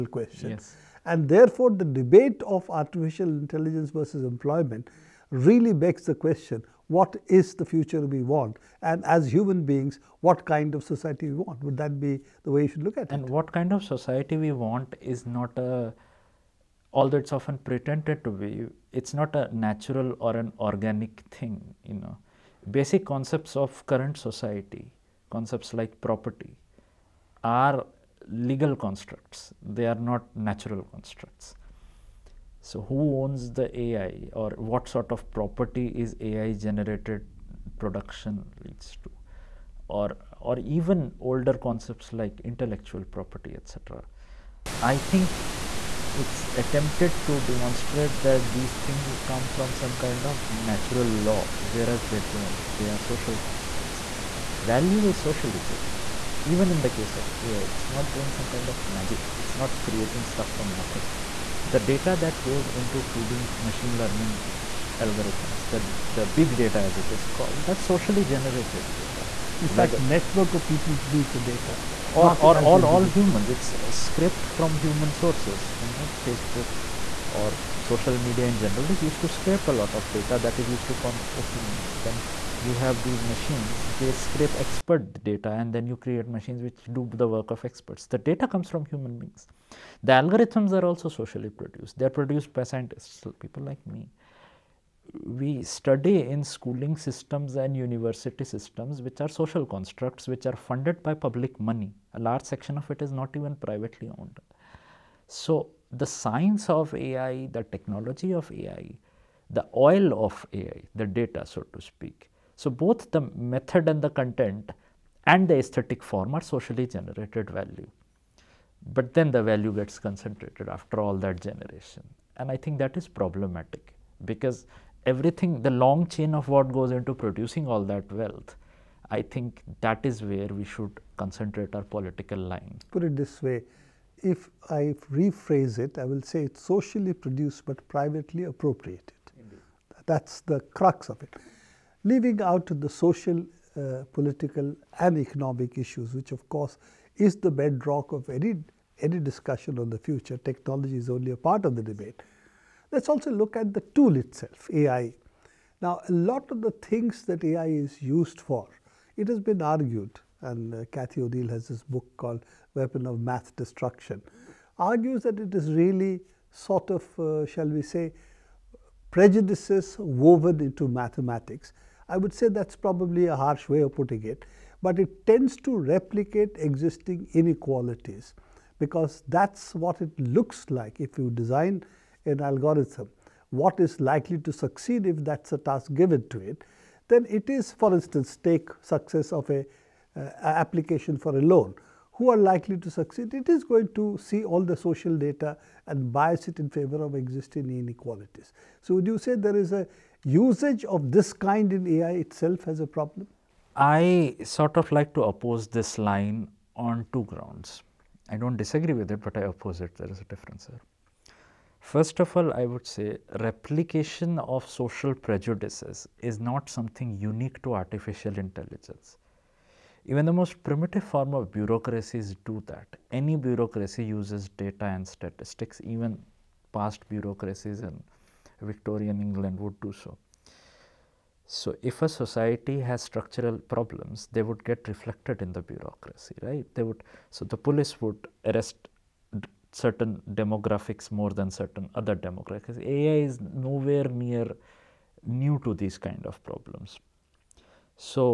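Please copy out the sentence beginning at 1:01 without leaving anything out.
The data that goes into feeding machine learning eh, algorithms, the, the big data as it is called, that's socially generated data.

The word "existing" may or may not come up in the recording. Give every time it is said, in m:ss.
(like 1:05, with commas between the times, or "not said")
2:56, 3:17.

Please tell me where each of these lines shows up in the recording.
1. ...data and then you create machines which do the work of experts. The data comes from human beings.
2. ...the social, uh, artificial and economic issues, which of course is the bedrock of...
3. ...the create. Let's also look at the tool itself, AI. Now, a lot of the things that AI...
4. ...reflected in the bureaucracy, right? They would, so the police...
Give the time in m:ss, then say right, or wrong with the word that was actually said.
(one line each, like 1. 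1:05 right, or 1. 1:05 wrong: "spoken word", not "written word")
1. 1:25 right
2. 2:22 wrong: "political", not "artificial"
3. 2:31 wrong: "debate", not "create"
4. 3:54 right.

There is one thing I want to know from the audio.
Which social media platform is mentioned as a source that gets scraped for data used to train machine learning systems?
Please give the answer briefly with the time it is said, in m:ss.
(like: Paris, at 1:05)
Facebook, at 1:16.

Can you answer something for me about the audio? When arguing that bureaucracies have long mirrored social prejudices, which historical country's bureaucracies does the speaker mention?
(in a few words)
Victorian England.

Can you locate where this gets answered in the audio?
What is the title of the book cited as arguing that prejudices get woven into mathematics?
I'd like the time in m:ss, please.
2:42.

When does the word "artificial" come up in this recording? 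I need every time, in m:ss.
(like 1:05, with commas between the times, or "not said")
0:02, 3:37.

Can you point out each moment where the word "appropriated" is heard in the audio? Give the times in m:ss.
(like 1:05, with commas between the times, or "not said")
2:18.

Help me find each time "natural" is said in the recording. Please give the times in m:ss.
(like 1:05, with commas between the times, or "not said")
0:19, 0:30, 0:50.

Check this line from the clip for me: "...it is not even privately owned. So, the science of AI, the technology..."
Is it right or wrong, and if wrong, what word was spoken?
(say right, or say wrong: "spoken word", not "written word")
right.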